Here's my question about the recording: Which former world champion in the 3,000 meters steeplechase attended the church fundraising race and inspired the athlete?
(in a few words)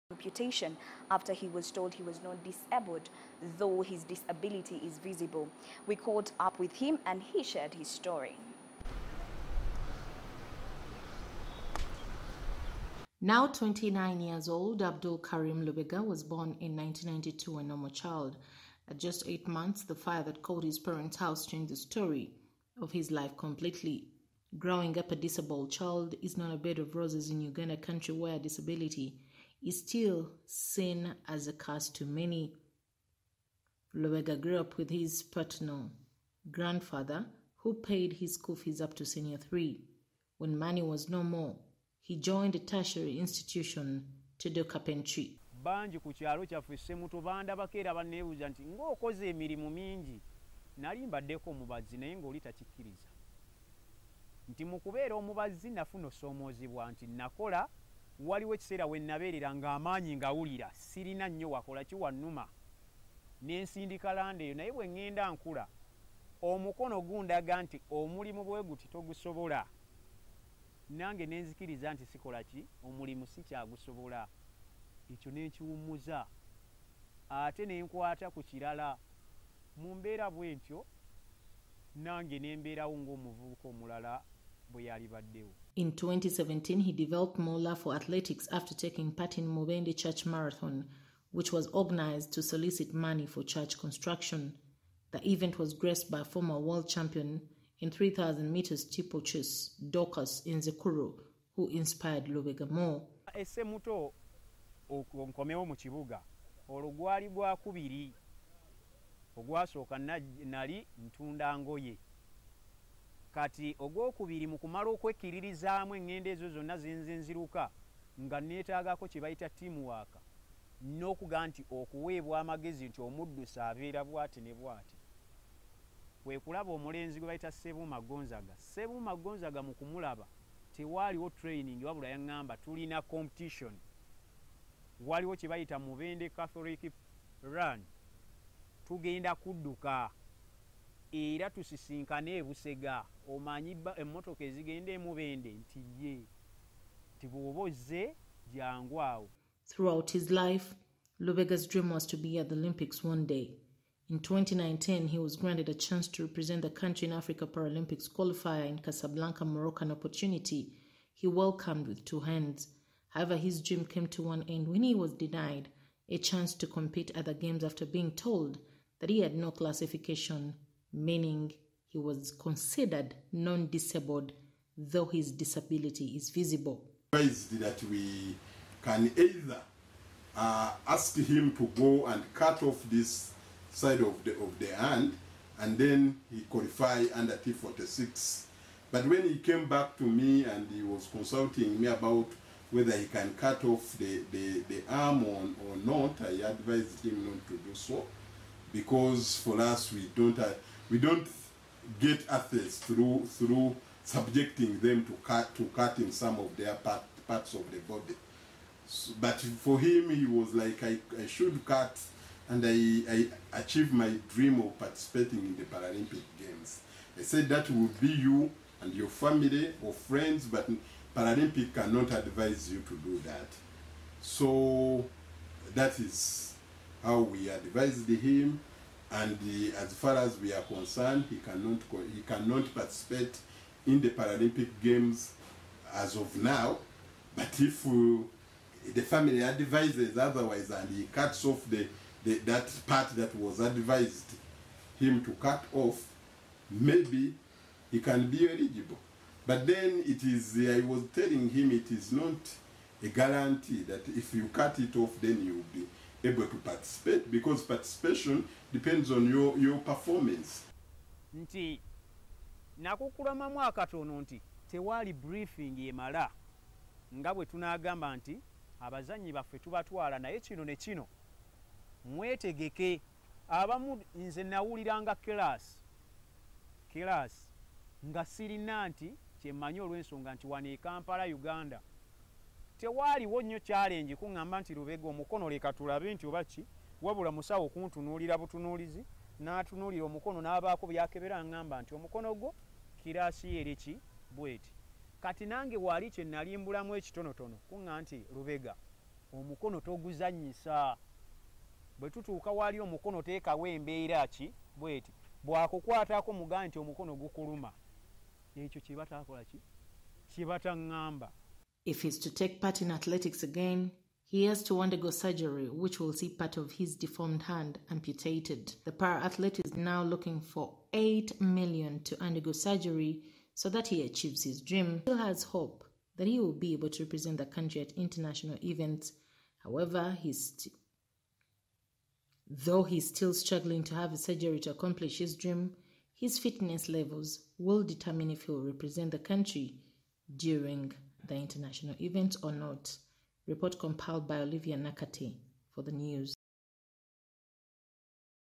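Dorcus Inzikuru.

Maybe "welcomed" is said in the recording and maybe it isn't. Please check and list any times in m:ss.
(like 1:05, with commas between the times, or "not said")
2:41.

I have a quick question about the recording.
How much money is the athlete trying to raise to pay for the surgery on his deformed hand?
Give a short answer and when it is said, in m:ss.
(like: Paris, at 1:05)
8 million, at 5:20.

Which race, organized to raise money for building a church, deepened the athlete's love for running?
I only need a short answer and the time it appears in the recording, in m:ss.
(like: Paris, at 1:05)
Mubende Church Marathon, at 1:29.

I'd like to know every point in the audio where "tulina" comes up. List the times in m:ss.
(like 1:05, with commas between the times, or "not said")
2:12.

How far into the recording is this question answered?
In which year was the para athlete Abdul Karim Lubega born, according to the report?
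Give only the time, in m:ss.
0:16.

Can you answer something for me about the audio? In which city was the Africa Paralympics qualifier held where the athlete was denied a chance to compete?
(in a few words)
Casablanca.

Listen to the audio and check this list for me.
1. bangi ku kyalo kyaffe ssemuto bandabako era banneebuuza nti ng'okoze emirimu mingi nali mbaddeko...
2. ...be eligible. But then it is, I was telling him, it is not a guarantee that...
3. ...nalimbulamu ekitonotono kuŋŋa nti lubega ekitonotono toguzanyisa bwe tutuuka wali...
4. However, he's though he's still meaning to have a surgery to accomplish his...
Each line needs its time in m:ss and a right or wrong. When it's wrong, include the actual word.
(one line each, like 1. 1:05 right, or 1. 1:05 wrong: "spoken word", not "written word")
1. 0:45 right
2. 4:08 right
3. 4:56 wrong: "omukono", not "ekitonotono"
4. 5:29 wrong: "struggling", not "meaning".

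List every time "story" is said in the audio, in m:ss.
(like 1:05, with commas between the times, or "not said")
0:07, 0:21.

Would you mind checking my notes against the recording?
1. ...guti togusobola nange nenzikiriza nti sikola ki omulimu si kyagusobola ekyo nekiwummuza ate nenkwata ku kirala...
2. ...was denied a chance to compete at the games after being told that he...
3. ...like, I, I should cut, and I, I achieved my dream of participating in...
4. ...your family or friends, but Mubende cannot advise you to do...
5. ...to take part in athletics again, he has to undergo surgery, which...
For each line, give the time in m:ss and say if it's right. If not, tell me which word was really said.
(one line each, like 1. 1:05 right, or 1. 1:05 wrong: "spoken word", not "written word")
1. 1:08 right
2. 2:44 right
3. 3:30 right
4. 3:38 wrong: "Paralympic", not "Mubende"
5. 5:12 right.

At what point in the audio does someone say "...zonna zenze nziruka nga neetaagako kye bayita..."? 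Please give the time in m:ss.
1:56.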